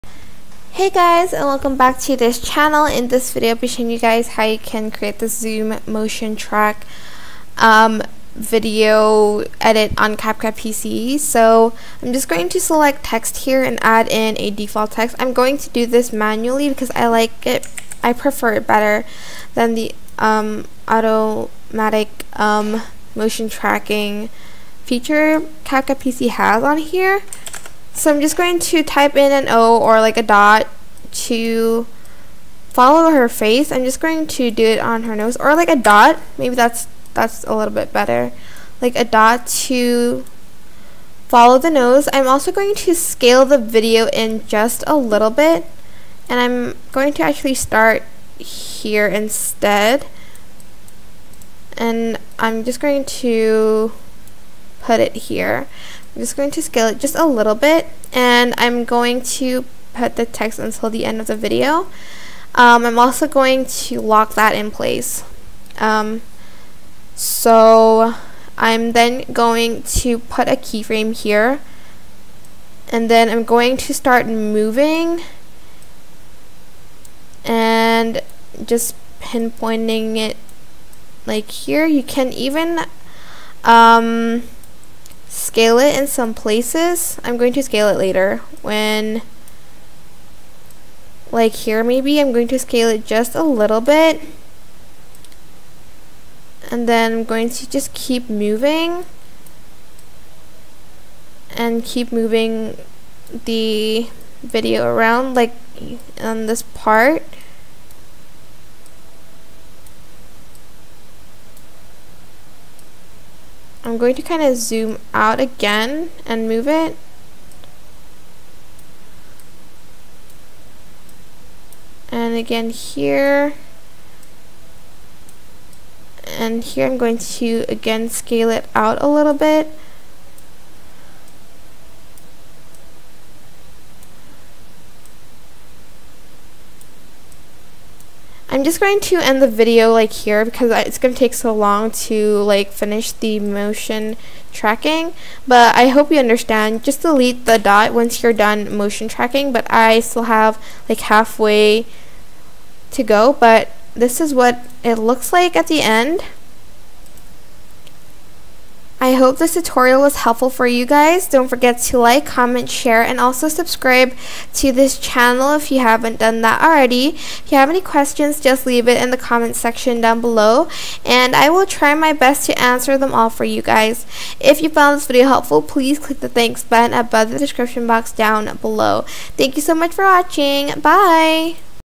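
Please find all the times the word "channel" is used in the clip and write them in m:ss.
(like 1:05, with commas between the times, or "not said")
0:02, 2:44.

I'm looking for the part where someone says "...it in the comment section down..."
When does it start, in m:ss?
2:48.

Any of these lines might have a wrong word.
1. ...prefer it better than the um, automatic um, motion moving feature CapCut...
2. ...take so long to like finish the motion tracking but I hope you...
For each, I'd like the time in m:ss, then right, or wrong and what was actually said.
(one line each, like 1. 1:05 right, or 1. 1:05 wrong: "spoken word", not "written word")
1. 0:18 wrong: "tracking", not "moving"
2. 2:21 right.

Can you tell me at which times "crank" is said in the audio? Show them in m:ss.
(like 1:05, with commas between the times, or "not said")
not said.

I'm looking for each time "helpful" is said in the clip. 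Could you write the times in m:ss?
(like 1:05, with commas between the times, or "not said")
2:40, 2:55.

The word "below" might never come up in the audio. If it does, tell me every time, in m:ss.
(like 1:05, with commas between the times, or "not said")
2:50, 2:58.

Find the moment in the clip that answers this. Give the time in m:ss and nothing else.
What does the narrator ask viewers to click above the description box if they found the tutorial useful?
2:56.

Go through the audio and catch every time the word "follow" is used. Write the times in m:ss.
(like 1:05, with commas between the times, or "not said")
0:32, 0:41.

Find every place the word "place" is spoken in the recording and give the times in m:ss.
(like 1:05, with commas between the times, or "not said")
1:04, 1:26.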